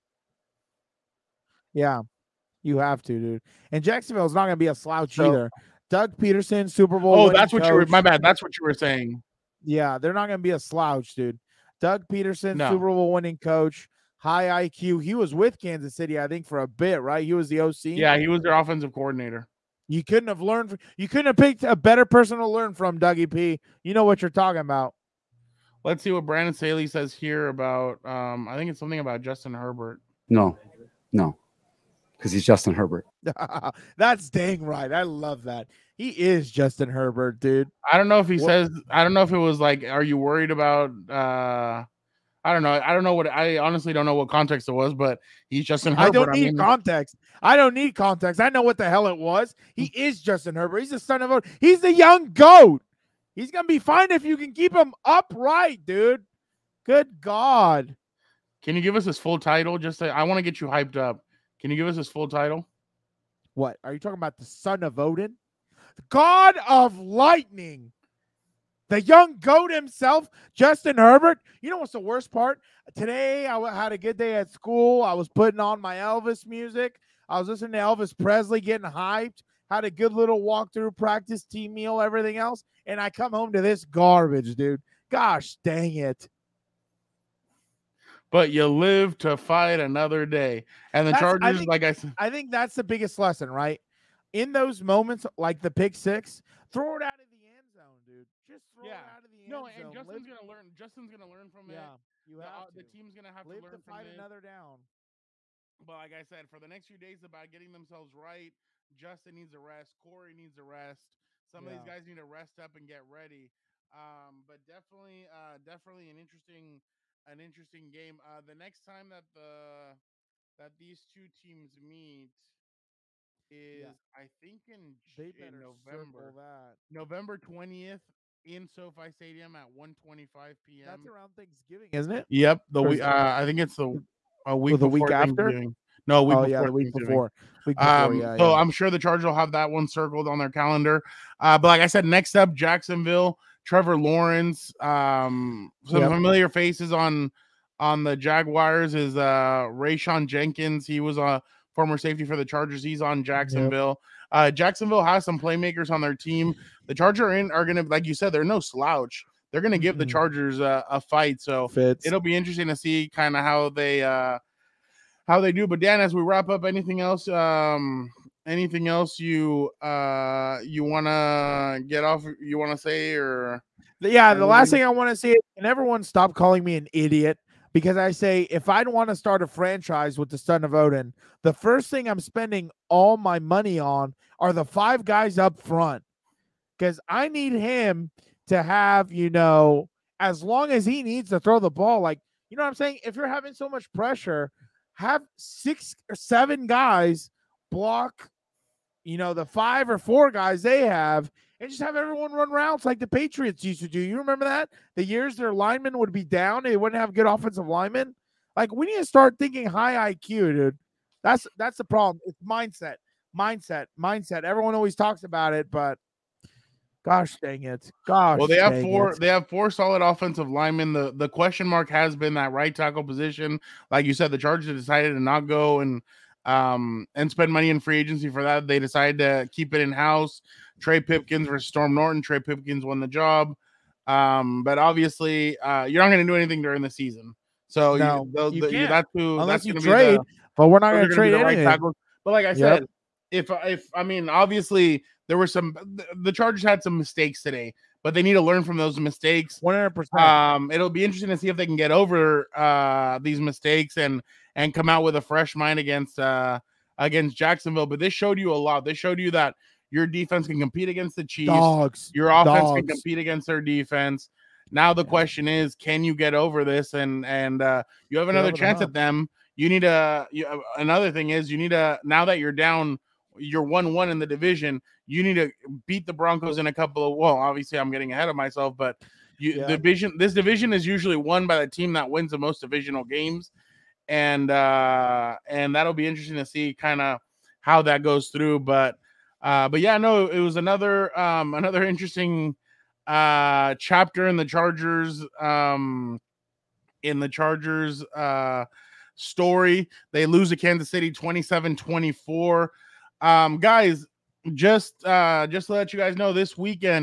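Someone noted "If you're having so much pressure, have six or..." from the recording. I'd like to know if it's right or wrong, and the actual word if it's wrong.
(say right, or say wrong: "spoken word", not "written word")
right.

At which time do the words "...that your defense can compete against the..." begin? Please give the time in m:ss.
4:19.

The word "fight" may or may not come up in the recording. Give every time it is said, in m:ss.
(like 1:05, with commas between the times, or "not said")
1:29, 1:43, 2:40.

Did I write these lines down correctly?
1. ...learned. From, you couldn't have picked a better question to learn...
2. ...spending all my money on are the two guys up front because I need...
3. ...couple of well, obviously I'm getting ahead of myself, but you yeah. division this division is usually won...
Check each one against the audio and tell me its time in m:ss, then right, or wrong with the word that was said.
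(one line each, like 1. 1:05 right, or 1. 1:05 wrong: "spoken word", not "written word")
1. 0:20 wrong: "person", not "question"
2. 3:02 wrong: "five", not "two"
3. 4:36 right.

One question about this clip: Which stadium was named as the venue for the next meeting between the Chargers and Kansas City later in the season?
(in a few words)
SoFi Stadium.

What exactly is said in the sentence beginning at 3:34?
Everyone always talks about it, but gosh dang it, gosh.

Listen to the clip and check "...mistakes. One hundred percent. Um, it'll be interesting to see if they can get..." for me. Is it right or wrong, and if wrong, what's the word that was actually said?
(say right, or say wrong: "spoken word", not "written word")
right.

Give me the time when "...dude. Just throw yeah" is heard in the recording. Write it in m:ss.
1:38.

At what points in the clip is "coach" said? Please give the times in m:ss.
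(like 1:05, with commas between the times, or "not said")
0:07, 0:13.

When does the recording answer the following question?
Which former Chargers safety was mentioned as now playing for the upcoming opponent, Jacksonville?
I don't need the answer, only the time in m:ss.
2:29.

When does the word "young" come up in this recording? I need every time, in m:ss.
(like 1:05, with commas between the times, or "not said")
0:51, 1:09.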